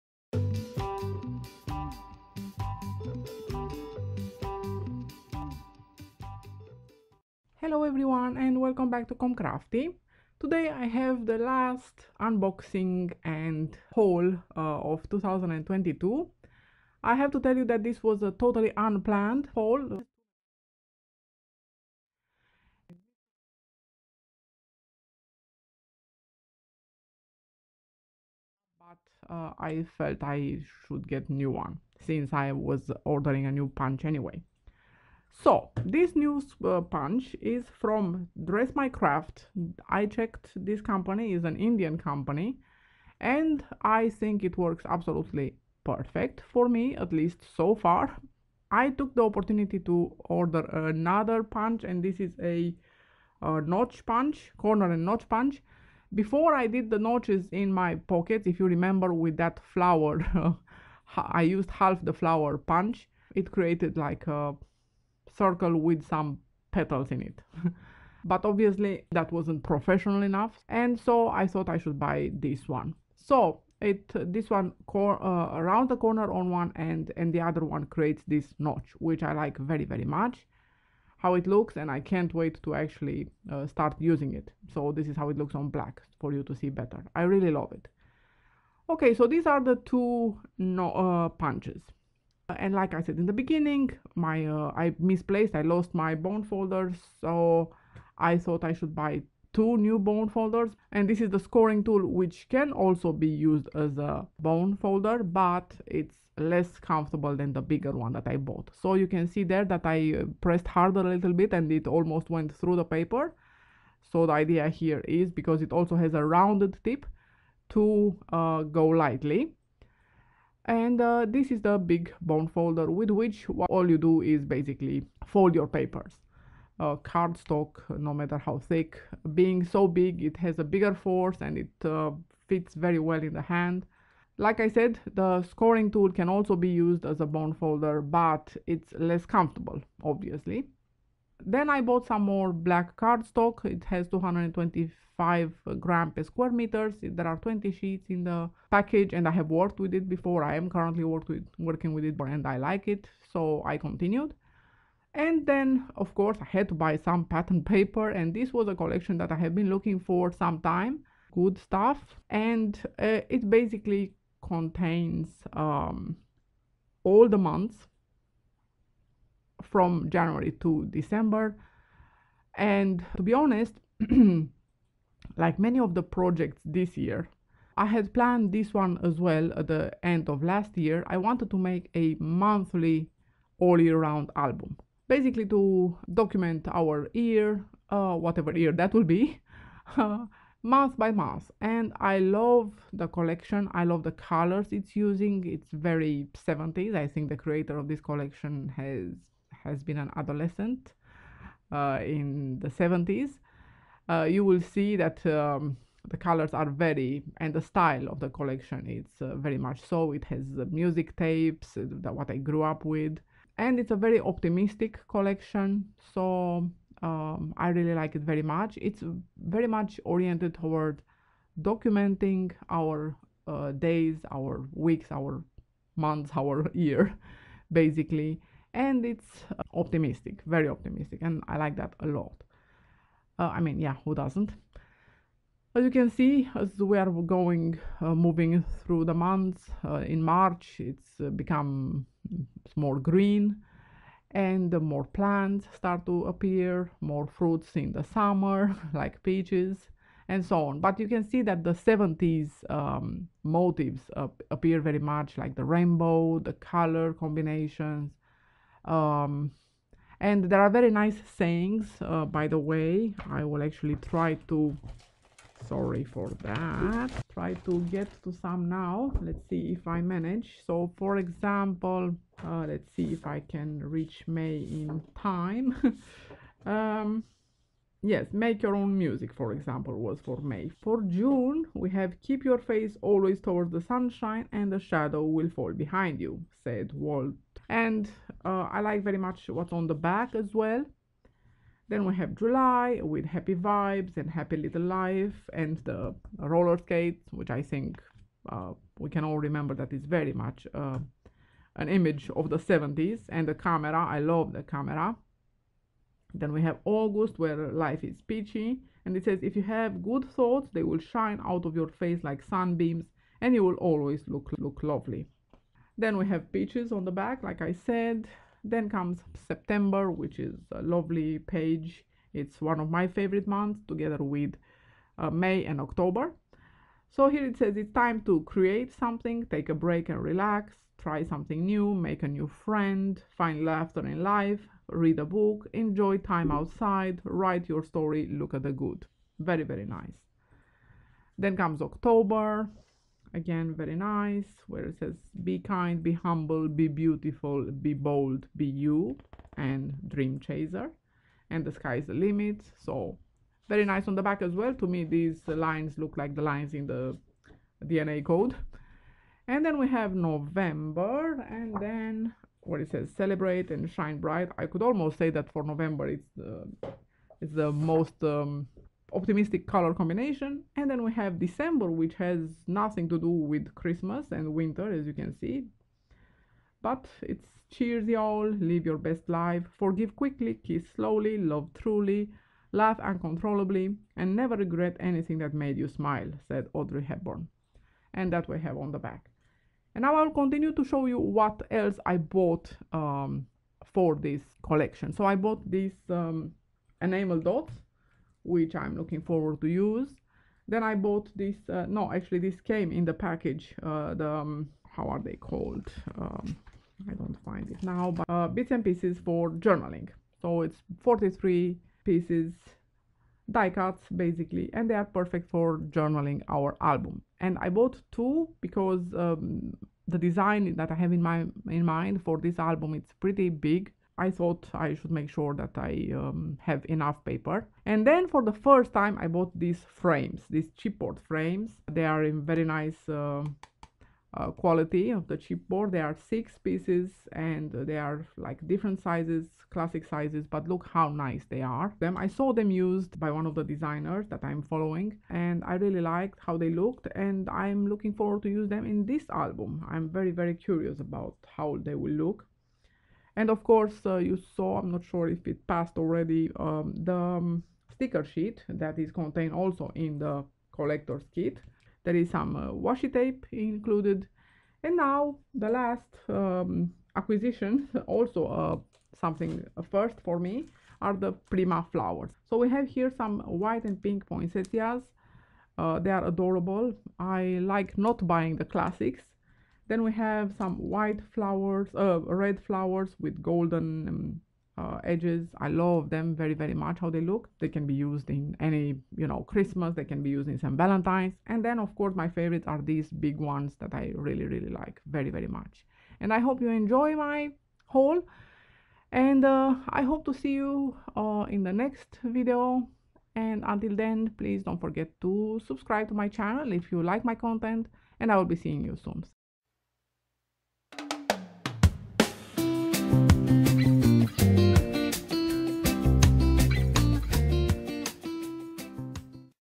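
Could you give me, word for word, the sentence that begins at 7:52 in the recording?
So we have here some white and pink poinsettias.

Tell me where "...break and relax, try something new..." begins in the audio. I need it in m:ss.
5:29.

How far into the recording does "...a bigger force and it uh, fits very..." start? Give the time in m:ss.
2:10.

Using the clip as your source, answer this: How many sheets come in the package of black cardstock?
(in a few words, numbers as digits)
20.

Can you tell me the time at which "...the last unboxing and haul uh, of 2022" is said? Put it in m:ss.
0:11.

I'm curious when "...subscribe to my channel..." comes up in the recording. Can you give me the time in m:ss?
8:25.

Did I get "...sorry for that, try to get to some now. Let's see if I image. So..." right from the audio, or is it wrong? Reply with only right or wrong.
wrong.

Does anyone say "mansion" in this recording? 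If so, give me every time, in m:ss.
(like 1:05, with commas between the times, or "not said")
not said.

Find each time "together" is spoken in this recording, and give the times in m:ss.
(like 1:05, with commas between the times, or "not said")
5:23.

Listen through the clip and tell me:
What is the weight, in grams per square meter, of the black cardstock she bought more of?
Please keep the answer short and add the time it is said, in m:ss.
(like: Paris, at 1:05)
225, at 2:24.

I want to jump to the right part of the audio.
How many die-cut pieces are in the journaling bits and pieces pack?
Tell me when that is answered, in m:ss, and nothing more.
6:51.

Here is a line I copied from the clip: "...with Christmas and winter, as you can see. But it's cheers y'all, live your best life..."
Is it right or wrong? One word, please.
right.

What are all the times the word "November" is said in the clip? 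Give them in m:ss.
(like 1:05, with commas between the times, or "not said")
6:00, 6:05.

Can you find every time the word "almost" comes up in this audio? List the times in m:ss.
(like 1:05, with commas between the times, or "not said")
1:51, 6:04.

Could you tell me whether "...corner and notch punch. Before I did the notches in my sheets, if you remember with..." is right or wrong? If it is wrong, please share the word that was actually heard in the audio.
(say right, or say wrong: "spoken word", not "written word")
wrong: "pockets", not "sheets".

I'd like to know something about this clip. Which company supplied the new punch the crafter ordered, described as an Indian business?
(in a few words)
Dress My Craft.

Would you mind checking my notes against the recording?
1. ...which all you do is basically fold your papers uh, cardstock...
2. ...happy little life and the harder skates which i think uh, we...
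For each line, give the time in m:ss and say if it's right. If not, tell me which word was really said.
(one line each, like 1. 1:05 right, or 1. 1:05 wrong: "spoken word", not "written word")
1. 2:03 right
2. 4:54 wrong: "roller", not "harder".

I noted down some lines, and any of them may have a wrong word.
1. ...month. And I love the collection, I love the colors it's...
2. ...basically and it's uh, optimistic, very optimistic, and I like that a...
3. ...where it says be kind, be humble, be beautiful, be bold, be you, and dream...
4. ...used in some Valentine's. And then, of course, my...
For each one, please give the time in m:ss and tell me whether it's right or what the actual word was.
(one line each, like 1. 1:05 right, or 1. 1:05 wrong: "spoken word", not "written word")
1. 3:11 right
2. 3:47 right
3. 5:44 right
4. 8:10 right.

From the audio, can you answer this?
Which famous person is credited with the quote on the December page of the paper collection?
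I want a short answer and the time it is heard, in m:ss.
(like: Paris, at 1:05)
Audrey Hepburn, at 6:26.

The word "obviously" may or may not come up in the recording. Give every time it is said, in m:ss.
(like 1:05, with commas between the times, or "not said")
1:08, 2:20.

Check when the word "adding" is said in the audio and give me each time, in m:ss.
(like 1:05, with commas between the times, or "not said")
not said.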